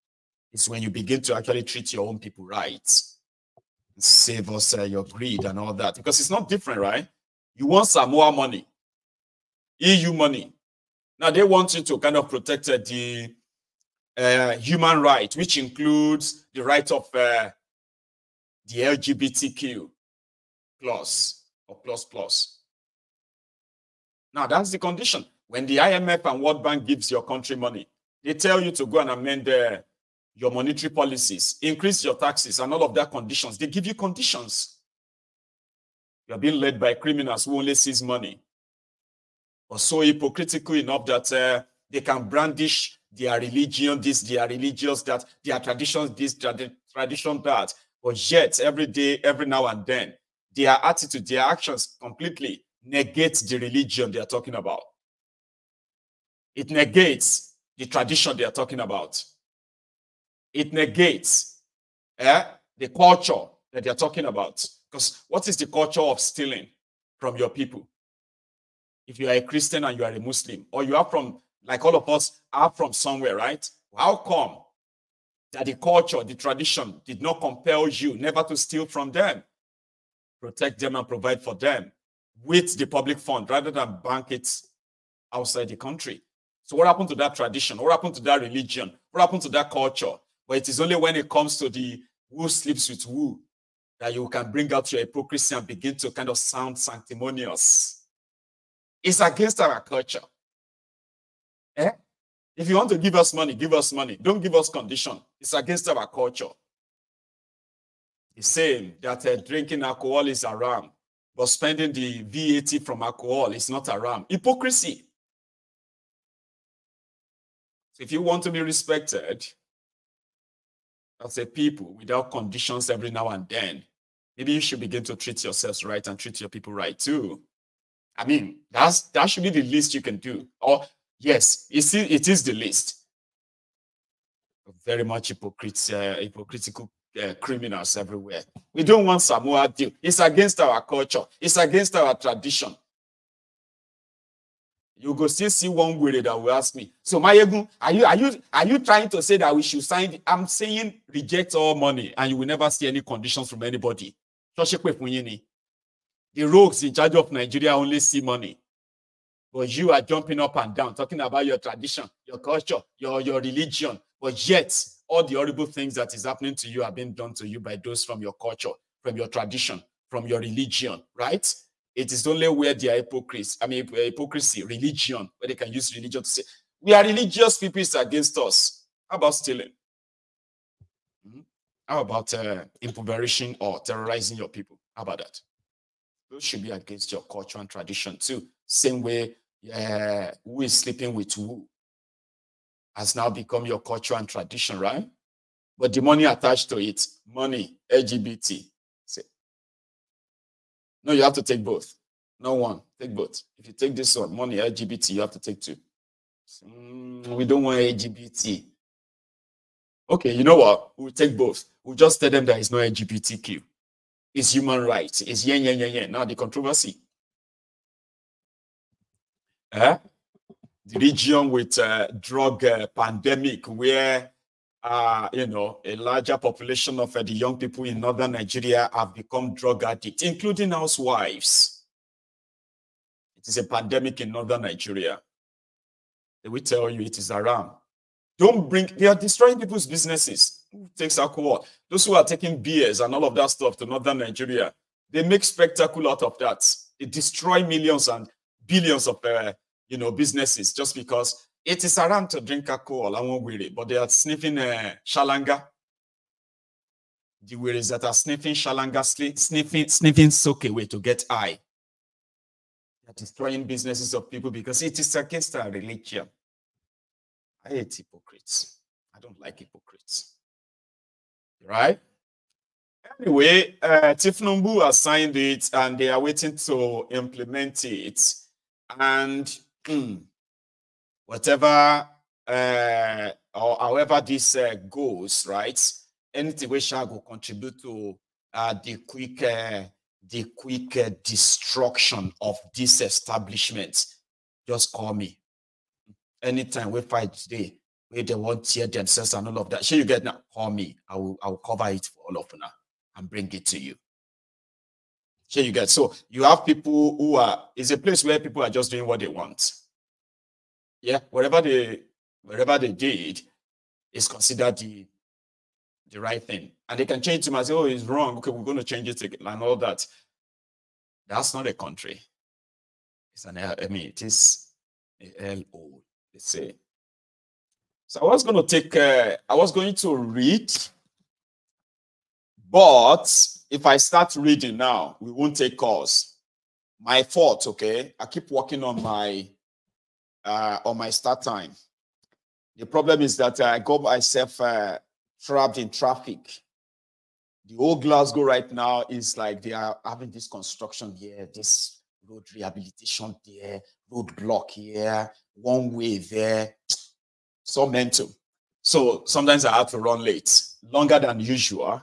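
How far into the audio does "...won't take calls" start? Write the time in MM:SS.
05:35.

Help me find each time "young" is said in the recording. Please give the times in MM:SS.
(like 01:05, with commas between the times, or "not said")
03:47.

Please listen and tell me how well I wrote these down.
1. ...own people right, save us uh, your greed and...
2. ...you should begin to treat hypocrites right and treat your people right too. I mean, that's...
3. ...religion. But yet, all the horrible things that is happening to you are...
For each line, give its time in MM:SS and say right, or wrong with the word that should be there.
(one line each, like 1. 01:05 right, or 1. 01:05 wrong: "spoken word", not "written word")
1. 00:02 right
2. 02:04 wrong: "yourselves", not "hypocrites"
3. 02:43 right.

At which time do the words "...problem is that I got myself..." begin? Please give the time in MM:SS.
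05:42.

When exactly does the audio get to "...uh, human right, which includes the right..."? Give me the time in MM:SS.
00:14.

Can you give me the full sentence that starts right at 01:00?
It negates eh, the culture that they're talking about.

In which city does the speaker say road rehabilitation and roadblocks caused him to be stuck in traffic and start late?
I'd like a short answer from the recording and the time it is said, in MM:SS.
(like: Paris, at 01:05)
Glasgow, at 05:48.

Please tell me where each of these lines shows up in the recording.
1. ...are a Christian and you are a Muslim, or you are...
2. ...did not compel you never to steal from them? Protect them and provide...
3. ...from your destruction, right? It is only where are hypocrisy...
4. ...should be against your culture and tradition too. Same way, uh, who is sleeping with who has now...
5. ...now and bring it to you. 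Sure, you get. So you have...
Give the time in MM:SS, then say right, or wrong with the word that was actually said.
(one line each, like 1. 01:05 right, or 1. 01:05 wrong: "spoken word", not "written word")
1. 01:09 right
2. 01:17 right
3. 02:50 wrong: "religion", not "destruction"
4. 03:06 right
5. 05:02 right.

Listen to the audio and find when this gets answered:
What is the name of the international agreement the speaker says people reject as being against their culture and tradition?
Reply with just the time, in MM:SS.
02:19.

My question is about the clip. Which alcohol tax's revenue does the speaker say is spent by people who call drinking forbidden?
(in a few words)
VAT.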